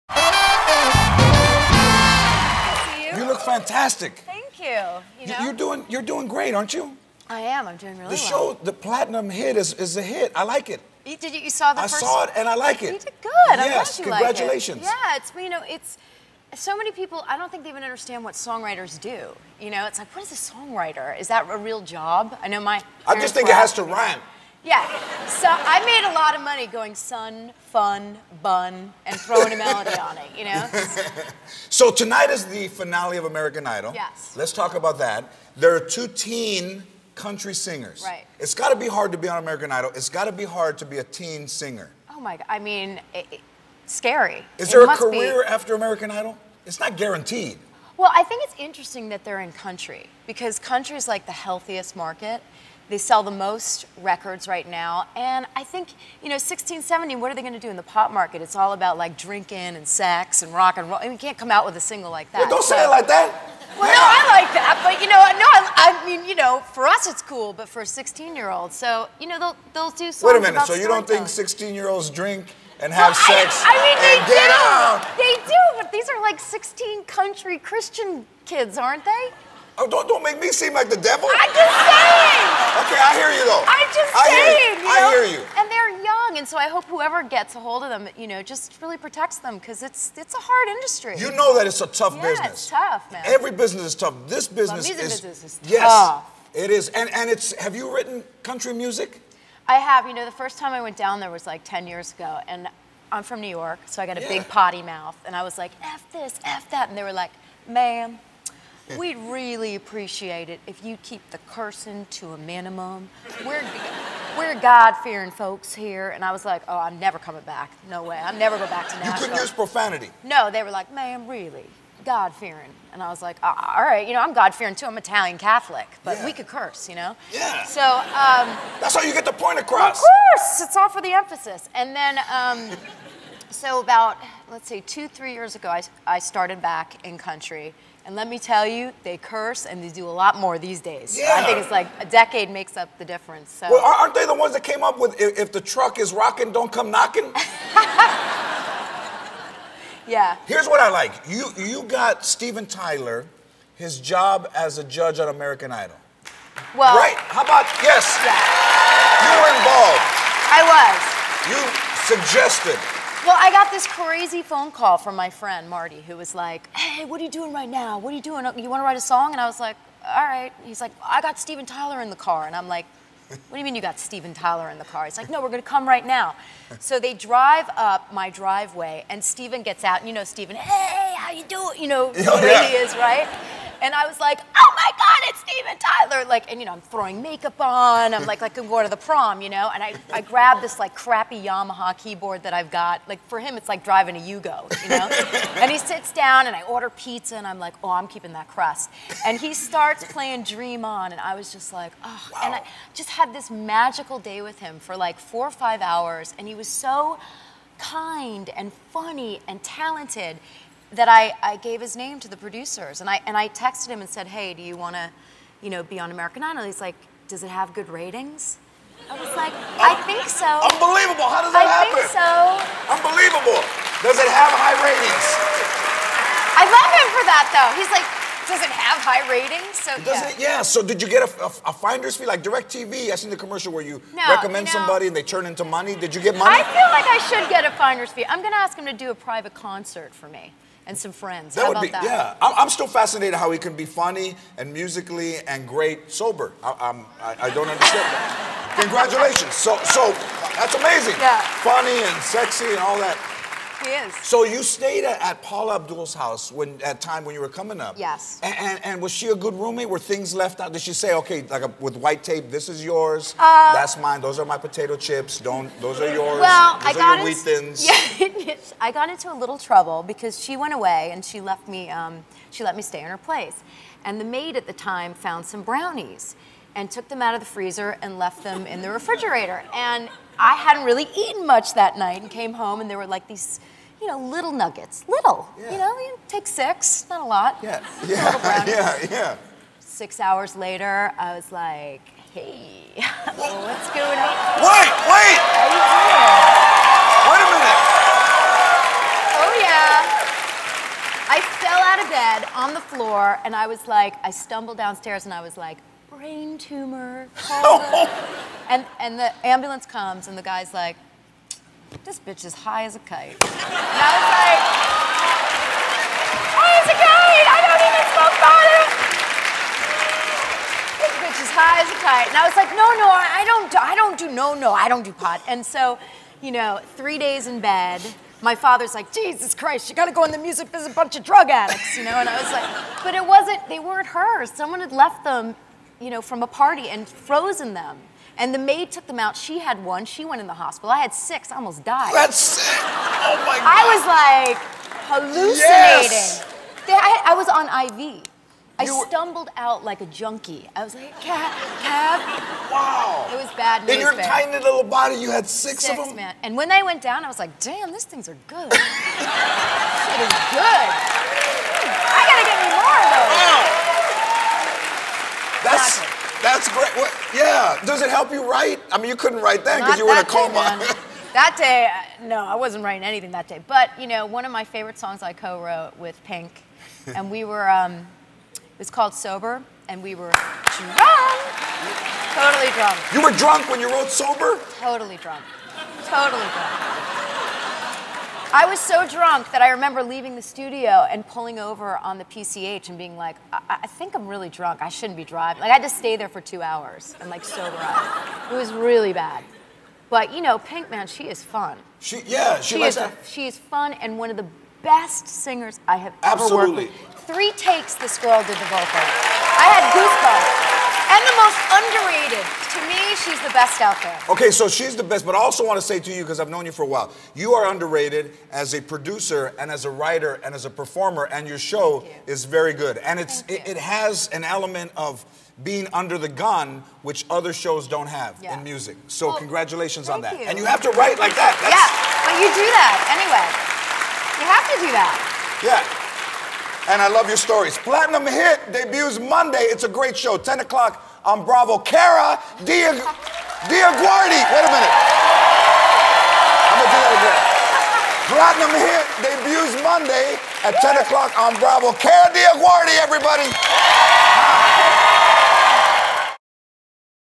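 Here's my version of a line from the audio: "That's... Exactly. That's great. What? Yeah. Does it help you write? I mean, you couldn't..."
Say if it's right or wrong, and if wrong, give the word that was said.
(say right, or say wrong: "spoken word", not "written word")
right.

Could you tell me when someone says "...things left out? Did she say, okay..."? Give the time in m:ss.
4:19.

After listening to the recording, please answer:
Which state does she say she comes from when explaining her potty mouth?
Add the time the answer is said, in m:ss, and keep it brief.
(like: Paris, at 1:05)
New York, at 1:43.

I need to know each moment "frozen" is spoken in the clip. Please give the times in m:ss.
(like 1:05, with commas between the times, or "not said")
5:37.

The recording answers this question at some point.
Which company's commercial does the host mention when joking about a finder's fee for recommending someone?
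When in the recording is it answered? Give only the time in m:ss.
3:52.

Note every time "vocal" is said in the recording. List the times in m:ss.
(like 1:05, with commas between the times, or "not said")
6:48.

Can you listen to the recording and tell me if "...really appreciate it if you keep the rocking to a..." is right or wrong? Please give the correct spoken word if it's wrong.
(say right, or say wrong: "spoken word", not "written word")
wrong: "cursing", not "rocking".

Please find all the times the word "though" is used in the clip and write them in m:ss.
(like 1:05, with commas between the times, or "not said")
1:23, 3:47.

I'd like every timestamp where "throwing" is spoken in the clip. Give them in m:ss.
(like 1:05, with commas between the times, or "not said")
0:29, 3:06.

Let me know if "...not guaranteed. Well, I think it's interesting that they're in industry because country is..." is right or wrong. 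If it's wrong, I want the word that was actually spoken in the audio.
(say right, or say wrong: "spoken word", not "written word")
wrong: "country", not "industry".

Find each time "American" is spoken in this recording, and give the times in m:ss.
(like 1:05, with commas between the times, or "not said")
0:33, 0:39, 0:45, 2:35, 3:36.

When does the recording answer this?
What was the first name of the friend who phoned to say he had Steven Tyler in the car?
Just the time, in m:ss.
2:45.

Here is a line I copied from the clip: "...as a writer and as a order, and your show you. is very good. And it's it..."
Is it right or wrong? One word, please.
wrong.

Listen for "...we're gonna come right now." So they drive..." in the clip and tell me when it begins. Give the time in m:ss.
2:55.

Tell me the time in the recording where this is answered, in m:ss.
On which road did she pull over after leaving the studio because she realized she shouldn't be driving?
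6:32.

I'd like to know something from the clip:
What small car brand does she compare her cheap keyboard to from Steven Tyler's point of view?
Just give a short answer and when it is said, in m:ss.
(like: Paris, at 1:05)
Yugo, at 3:14.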